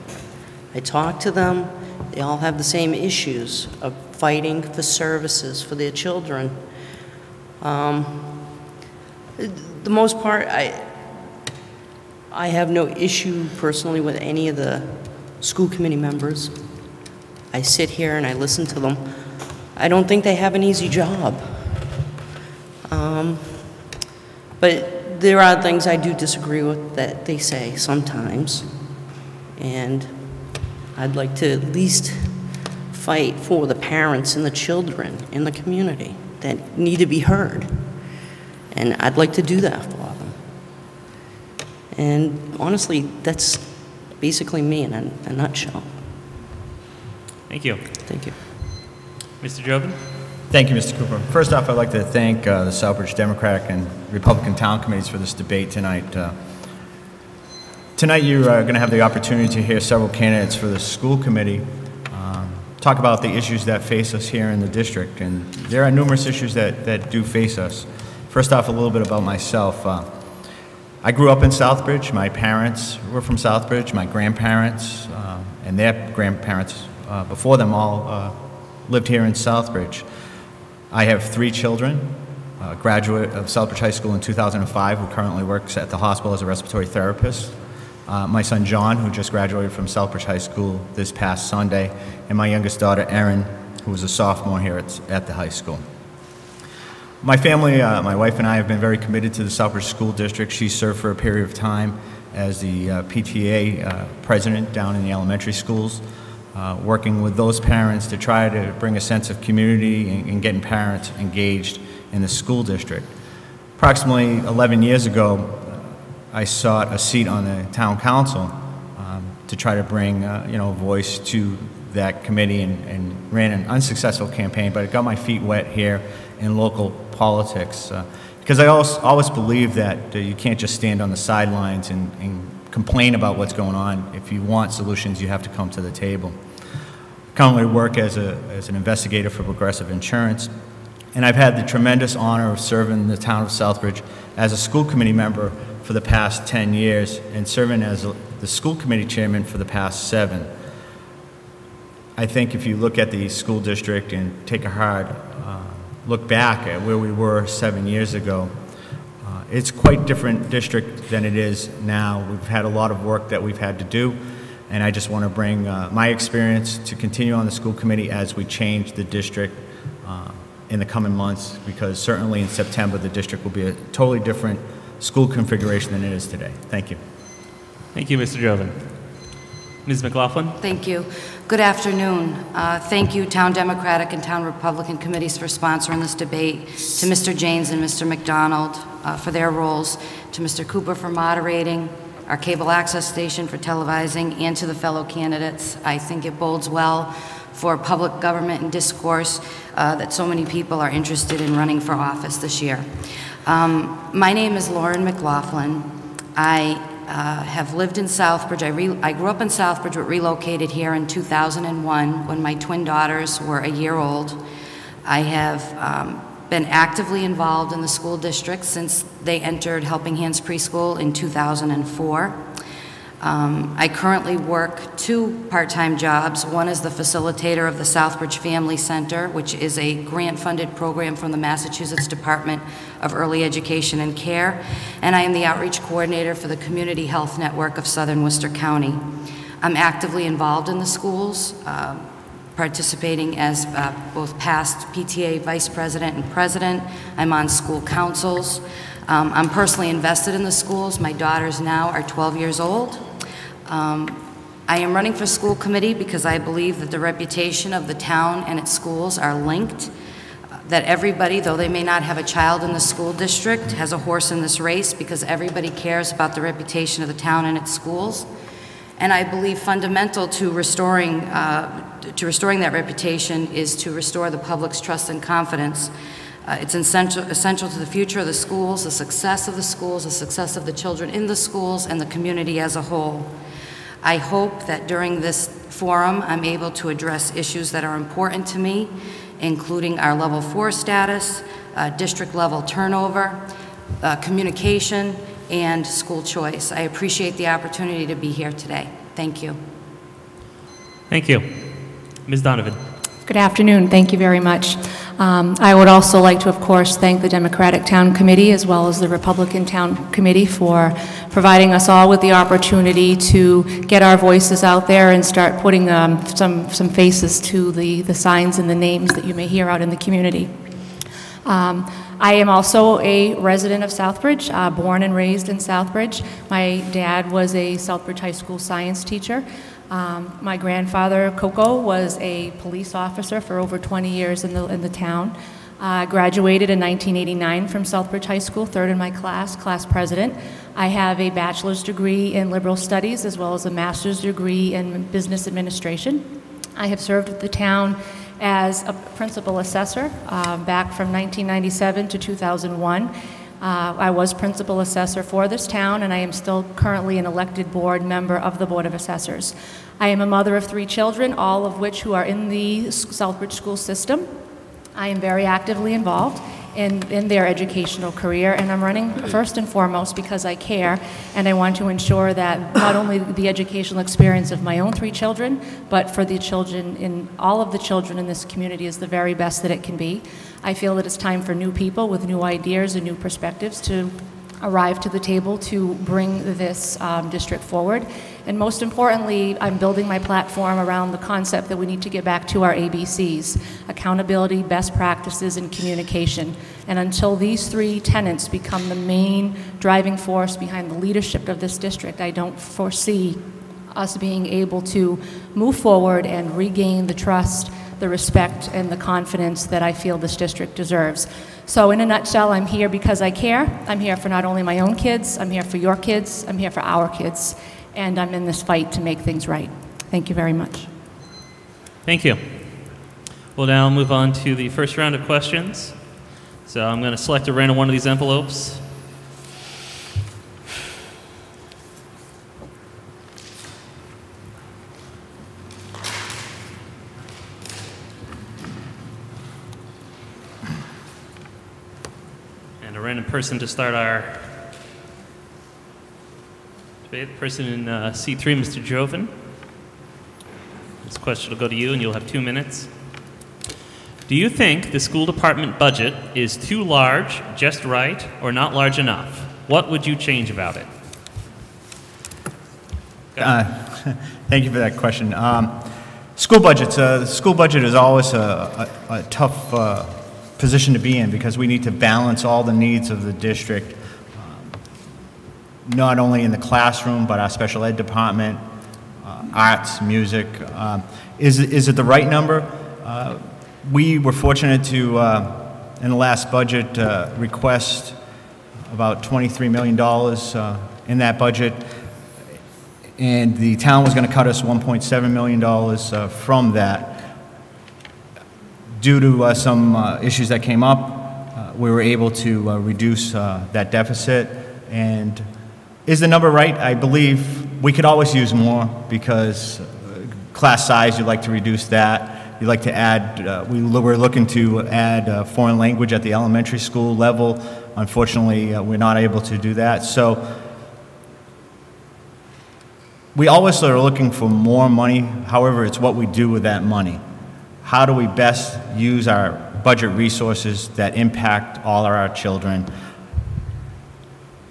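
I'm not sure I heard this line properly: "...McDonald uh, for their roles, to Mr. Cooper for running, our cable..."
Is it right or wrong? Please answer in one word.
wrong.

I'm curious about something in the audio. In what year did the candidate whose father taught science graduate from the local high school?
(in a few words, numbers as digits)
1989.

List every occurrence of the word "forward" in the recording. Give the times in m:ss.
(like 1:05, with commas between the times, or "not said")
6:27, 6:45.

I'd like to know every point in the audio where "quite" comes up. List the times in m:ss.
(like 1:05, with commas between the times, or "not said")
2:39.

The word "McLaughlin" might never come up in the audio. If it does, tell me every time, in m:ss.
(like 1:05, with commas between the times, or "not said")
3:00, 3:25.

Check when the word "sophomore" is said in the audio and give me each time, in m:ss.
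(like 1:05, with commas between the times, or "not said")
1:34.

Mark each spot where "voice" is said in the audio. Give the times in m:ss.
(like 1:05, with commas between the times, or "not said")
2:00, 5:14.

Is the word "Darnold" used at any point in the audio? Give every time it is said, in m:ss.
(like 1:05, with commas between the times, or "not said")
not said.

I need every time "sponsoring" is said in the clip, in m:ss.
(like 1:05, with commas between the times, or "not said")
3:05.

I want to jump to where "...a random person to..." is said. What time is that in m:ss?
7:22.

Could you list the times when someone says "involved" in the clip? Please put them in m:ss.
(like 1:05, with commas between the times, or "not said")
3:37, 4:00, 6:05.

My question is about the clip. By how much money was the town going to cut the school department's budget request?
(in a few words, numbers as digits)
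$1.7 million.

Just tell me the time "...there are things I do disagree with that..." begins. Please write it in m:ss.
0:25.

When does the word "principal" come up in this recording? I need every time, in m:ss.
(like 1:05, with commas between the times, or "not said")
5:49, 5:54.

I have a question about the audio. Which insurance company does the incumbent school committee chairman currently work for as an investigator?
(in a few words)
Progressive Insurance.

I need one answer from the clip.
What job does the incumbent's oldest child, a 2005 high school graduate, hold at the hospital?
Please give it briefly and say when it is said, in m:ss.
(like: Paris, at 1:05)
respiratory therapist, at 1:26.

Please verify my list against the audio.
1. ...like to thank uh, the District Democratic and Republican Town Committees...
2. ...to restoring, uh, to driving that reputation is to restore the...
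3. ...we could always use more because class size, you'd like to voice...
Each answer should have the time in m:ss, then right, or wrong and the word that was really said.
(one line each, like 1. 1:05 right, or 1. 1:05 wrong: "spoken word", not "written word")
1. 0:51 wrong: "Southbridge", not "District"
2. 4:30 wrong: "restoring", not "driving"
3. 8:27 wrong: "reduce", not "voice".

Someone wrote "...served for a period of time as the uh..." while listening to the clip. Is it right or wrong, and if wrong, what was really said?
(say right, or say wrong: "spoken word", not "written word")
right.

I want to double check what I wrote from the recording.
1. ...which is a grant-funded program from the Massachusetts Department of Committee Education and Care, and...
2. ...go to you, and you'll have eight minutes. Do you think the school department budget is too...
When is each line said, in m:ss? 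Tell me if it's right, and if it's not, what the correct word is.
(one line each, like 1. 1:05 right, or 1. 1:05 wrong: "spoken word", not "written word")
1. 3:49 wrong: "Early", not "Committee"
2. 7:31 wrong: "two", not "eight".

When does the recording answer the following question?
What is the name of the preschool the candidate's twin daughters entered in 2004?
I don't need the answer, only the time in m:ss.
3:39.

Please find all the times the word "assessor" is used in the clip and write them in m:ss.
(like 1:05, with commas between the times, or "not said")
5:49, 5:54, 5:58.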